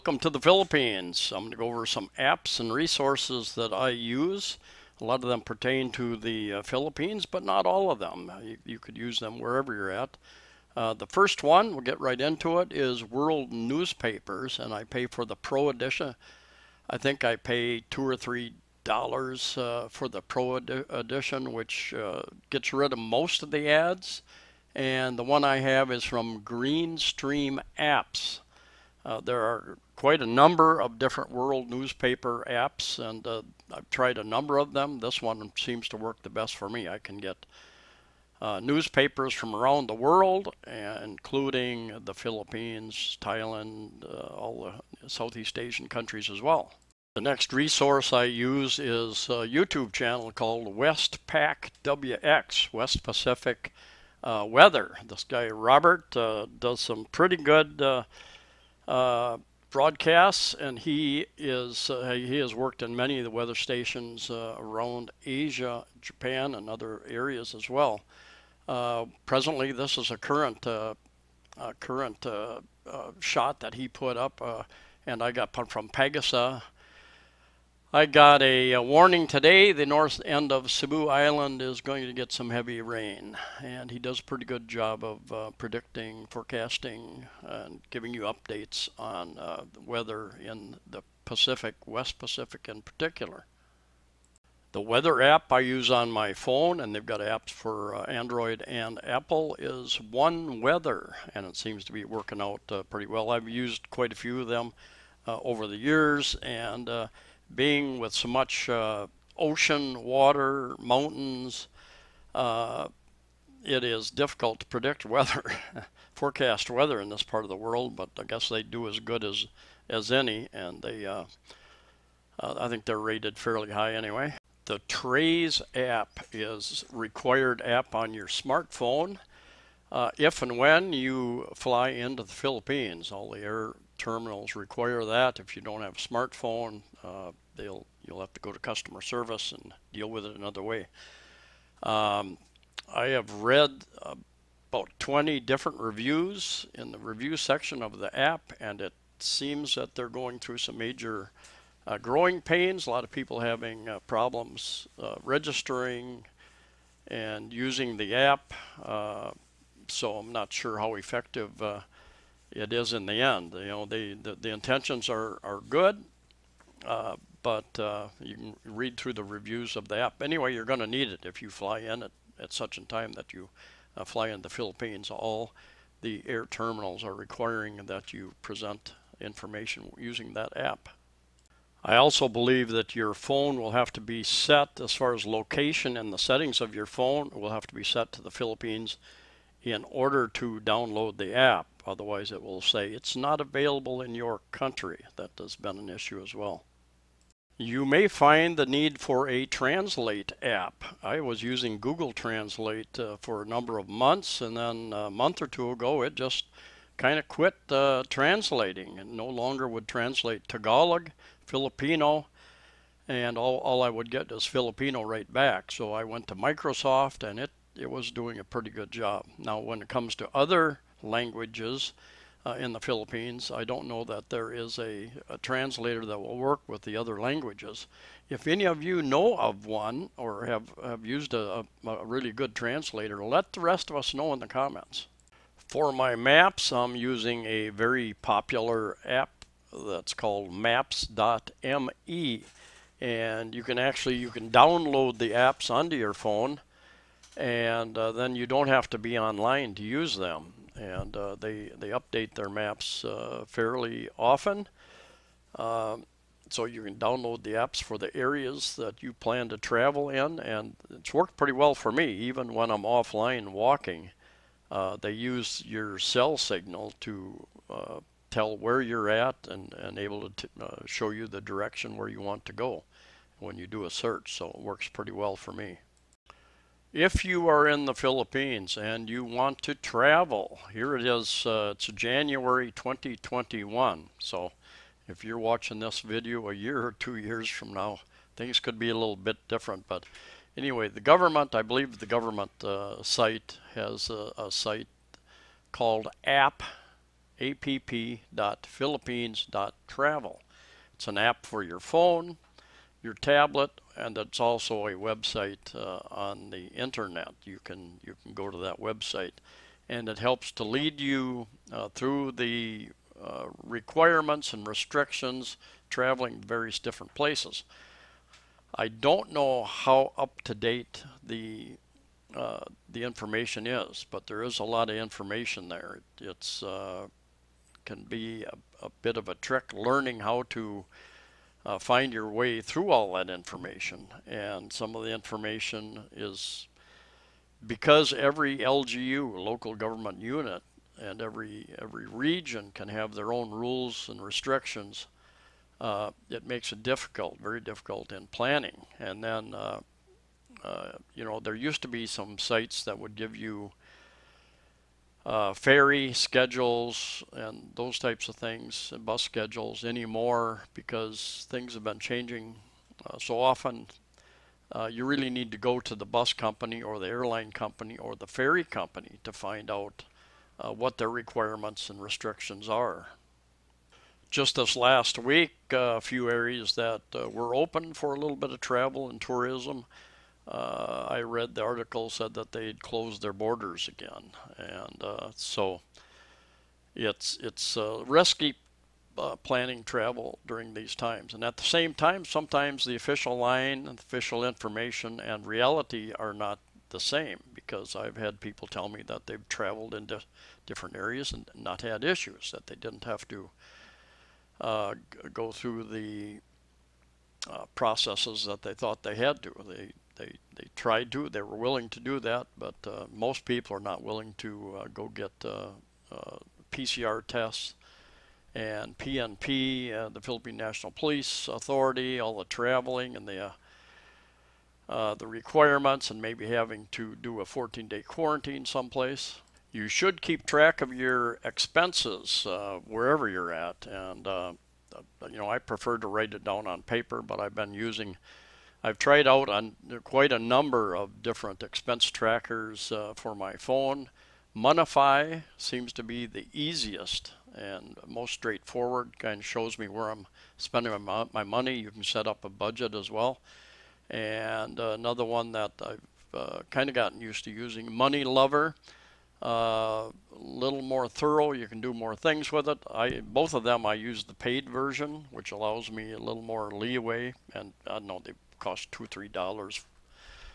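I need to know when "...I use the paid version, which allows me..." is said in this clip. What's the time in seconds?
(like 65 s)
463 s.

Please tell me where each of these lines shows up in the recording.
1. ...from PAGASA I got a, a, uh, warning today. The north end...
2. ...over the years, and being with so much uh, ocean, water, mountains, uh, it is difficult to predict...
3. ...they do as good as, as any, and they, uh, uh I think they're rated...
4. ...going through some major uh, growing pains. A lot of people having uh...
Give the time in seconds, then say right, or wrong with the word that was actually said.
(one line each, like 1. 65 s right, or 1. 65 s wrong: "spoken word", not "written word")
1. 75 s right
2. 105 s right
3. 118 s right
4. 150 s right.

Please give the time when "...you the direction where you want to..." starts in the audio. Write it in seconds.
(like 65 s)
271 s.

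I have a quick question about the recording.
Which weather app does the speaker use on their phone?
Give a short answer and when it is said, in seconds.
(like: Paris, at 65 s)
One Weather, at 100 s.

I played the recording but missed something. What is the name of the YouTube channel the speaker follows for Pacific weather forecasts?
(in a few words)
Westpac WX.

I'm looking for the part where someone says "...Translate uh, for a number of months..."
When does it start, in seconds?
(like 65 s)
202 s.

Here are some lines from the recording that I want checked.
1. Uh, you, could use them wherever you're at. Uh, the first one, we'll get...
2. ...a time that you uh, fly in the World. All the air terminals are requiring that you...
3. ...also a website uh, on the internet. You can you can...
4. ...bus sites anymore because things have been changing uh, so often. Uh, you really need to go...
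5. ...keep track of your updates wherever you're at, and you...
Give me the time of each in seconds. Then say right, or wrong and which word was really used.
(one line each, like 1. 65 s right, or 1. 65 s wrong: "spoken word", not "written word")
1. 8 s right
2. 172 s wrong: "Philippines", not "World"
3. 304 s right
4. 359 s wrong: "schedules", not "sites"
5. 430 s wrong: "expenses", not "updates".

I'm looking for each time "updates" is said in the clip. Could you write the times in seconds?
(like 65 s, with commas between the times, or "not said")
88 s, 251 s.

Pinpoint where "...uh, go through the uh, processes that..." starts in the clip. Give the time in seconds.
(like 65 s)
404 s.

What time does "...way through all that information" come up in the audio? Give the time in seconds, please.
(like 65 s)
332 s.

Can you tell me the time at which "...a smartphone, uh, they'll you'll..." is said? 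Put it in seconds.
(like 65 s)
135 s.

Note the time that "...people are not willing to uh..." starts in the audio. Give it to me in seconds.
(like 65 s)
413 s.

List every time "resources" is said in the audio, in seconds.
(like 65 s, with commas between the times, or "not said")
2 s, 47 s.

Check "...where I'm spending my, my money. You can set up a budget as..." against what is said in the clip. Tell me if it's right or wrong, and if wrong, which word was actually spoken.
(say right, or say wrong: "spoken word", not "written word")
right.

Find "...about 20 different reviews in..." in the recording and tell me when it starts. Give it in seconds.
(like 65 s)
144 s.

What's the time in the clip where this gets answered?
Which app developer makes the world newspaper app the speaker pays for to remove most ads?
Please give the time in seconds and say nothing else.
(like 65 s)
26 s.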